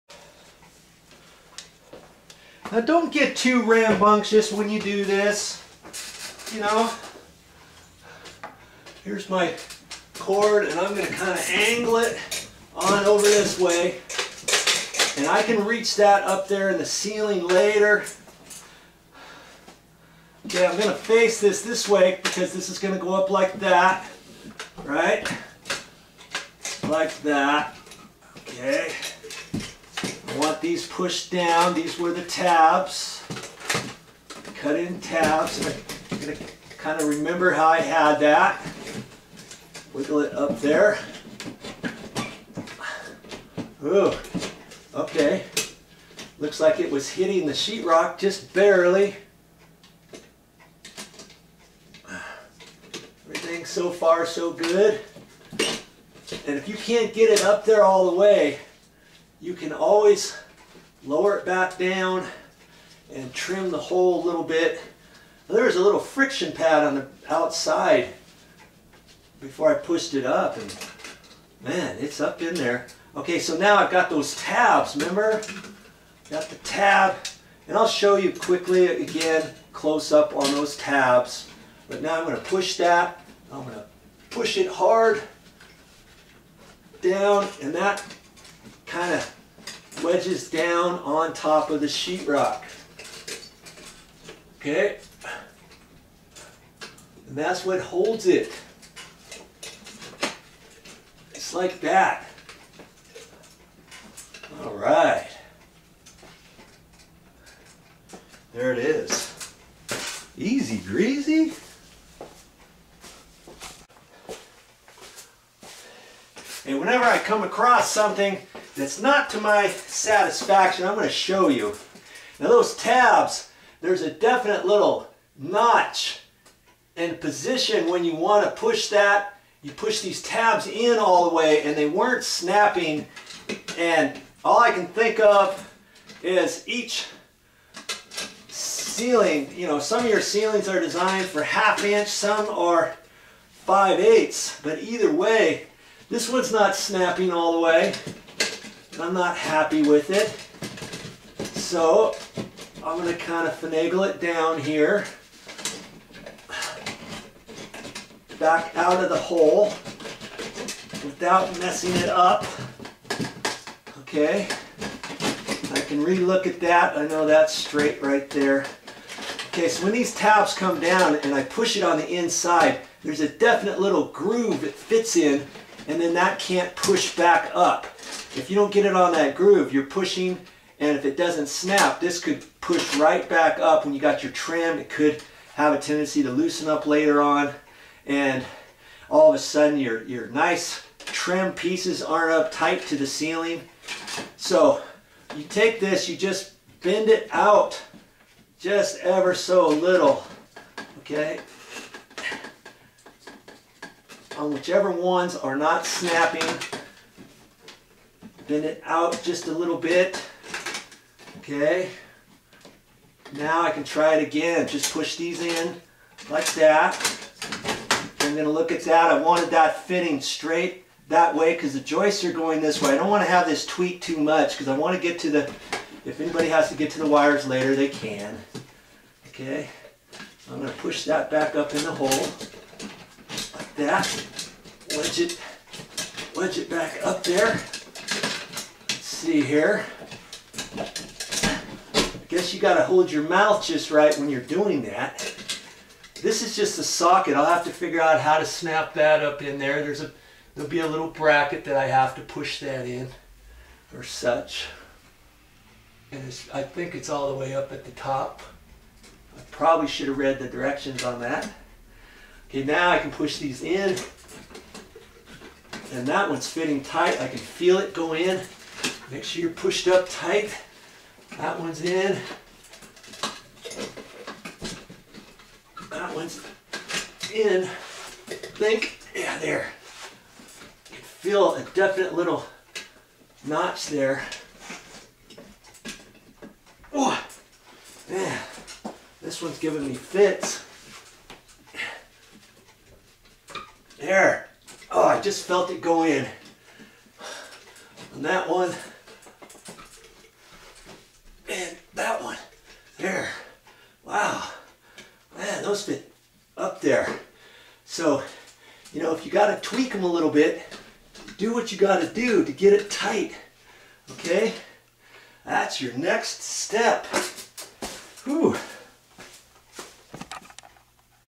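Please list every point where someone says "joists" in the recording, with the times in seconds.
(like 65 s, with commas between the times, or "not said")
221 s.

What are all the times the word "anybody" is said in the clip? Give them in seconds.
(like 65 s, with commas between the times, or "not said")
226 s.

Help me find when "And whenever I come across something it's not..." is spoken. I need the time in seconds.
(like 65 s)
116 s.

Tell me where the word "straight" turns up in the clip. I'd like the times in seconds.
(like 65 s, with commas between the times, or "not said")
167 s, 220 s.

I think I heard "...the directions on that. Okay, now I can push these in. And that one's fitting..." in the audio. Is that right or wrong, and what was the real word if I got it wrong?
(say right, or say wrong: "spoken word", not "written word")
right.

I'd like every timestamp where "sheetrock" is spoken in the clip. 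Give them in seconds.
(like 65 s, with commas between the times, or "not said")
47 s, 91 s.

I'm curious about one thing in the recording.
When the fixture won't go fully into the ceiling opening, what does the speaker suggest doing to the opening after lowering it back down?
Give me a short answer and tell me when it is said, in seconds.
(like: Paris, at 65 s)
trim the hole, at 63 s.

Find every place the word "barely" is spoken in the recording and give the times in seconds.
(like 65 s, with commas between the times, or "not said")
48 s.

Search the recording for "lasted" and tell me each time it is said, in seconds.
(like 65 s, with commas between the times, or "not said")
not said.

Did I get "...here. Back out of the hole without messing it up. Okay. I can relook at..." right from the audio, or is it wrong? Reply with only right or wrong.
right.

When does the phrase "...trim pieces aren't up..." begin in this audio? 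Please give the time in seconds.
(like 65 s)
190 s.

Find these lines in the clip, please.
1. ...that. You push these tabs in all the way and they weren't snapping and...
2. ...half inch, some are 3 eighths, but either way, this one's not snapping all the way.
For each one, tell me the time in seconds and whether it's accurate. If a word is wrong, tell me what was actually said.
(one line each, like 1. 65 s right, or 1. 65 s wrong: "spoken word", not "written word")
1. 128 s right
2. 141 s wrong: "5", not "3".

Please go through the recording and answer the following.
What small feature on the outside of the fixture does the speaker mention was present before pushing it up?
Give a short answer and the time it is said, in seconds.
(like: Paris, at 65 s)
friction pad, at 65 s.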